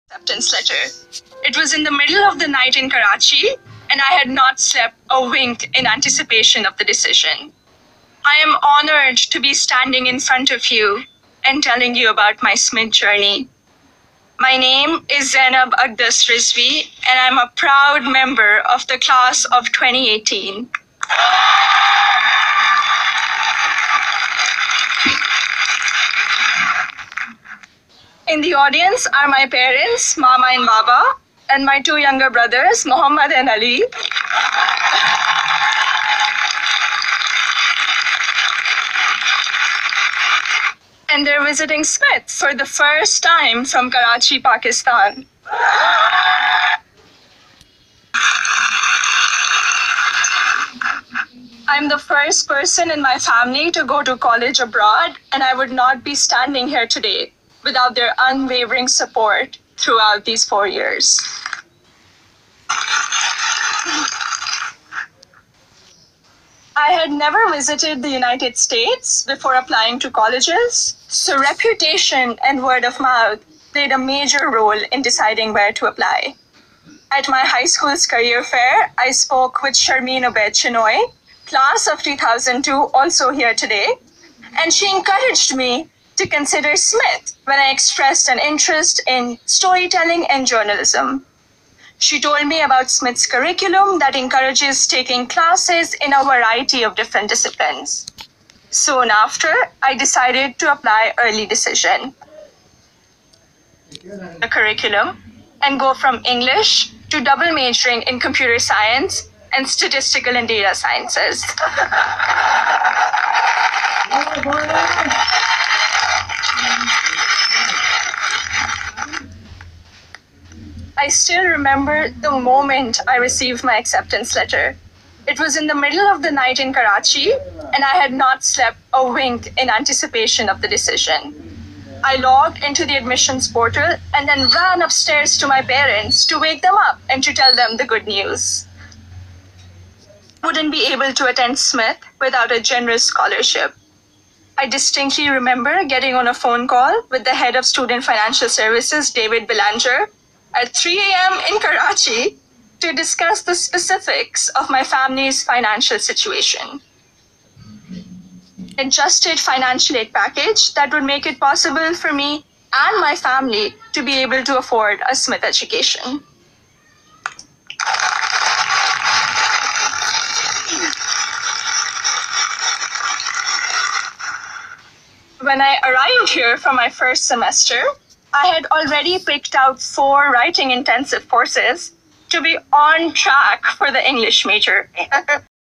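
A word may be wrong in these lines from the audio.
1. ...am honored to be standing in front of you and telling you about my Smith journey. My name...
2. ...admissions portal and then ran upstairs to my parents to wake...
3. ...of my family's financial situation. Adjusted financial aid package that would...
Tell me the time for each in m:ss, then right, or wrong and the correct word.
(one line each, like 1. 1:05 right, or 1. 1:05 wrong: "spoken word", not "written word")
1. 0:08 right
2. 2:12 right
3. 2:34 right.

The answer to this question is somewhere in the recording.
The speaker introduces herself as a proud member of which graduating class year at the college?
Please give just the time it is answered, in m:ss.
0:19.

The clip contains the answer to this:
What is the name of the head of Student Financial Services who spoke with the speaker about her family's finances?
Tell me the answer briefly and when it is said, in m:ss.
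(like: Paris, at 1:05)
David Belanger, at 2:29.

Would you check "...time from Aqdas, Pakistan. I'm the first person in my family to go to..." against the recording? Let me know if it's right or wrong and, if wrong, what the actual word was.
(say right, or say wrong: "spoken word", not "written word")
wrong: "Karachi", not "Aqdas".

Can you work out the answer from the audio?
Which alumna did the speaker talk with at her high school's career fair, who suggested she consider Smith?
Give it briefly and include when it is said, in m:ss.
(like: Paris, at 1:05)
Sharmeen Obaid, at 1:19.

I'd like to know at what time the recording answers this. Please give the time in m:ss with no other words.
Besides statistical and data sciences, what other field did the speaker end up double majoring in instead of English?
1:48.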